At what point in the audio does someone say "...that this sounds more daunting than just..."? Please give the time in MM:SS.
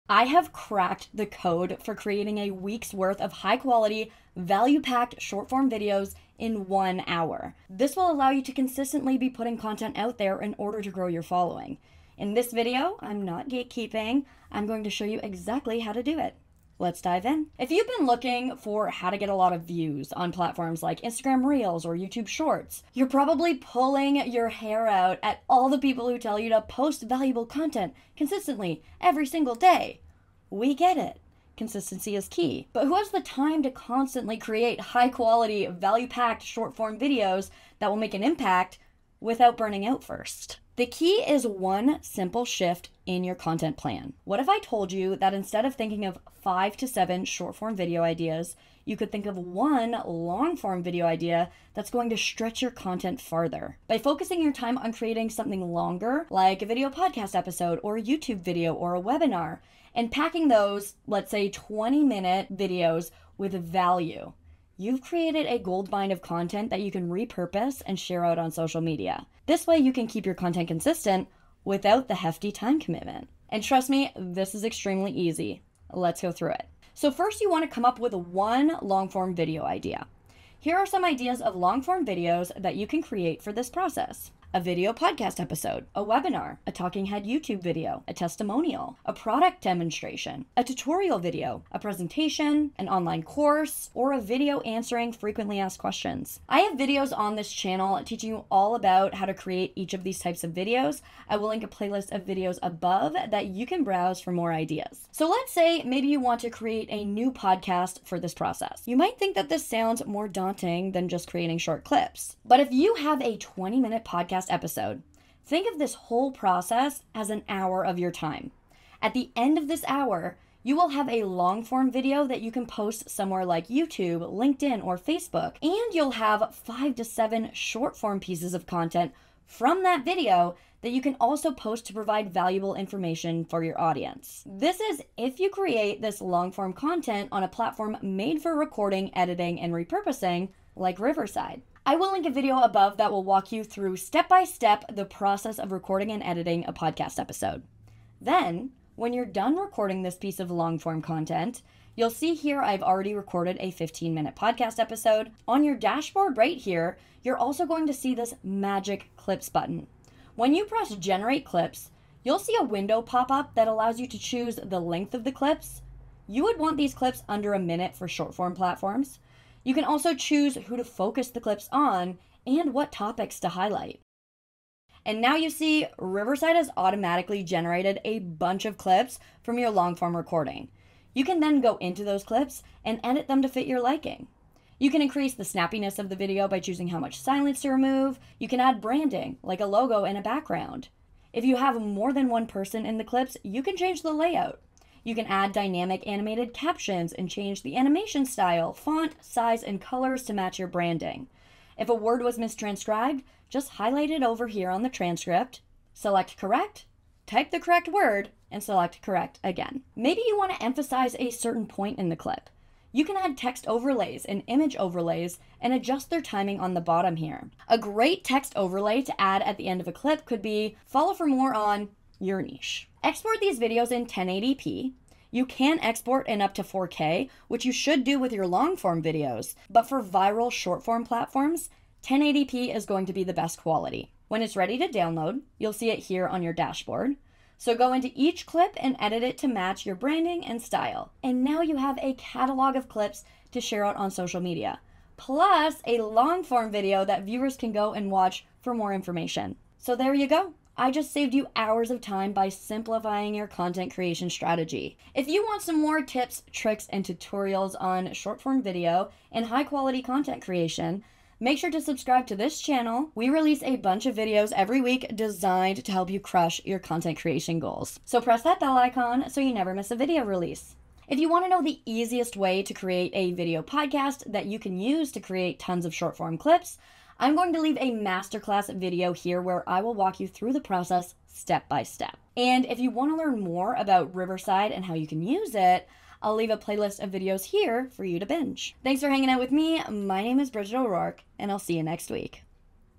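01:49.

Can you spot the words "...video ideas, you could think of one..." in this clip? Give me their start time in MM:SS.
00:47.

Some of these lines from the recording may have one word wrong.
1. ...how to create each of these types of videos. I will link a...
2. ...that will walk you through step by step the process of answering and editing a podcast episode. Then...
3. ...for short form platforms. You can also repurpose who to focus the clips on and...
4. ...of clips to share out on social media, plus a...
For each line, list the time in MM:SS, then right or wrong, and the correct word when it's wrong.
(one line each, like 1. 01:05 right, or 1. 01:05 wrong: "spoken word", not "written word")
1. 01:39 right
2. 02:22 wrong: "recording", not "answering"
3. 02:47 wrong: "choose", not "repurpose"
4. 04:02 right.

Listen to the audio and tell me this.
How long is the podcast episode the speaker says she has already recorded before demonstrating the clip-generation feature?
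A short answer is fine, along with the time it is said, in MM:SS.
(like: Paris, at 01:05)
15 minutes, at 02:33.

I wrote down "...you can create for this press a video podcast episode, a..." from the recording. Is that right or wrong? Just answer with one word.
wrong.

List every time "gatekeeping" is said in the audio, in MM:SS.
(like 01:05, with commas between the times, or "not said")
00:13.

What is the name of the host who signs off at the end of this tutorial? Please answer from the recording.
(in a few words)
Bridget O'Rourke.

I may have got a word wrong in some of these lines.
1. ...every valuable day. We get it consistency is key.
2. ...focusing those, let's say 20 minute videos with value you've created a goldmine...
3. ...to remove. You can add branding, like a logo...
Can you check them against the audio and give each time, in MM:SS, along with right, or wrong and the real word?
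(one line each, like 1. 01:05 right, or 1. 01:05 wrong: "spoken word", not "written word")
1. 00:28 wrong: "single", not "valuable"
2. 01:00 wrong: "packing", not "focusing"
3. 03:07 right.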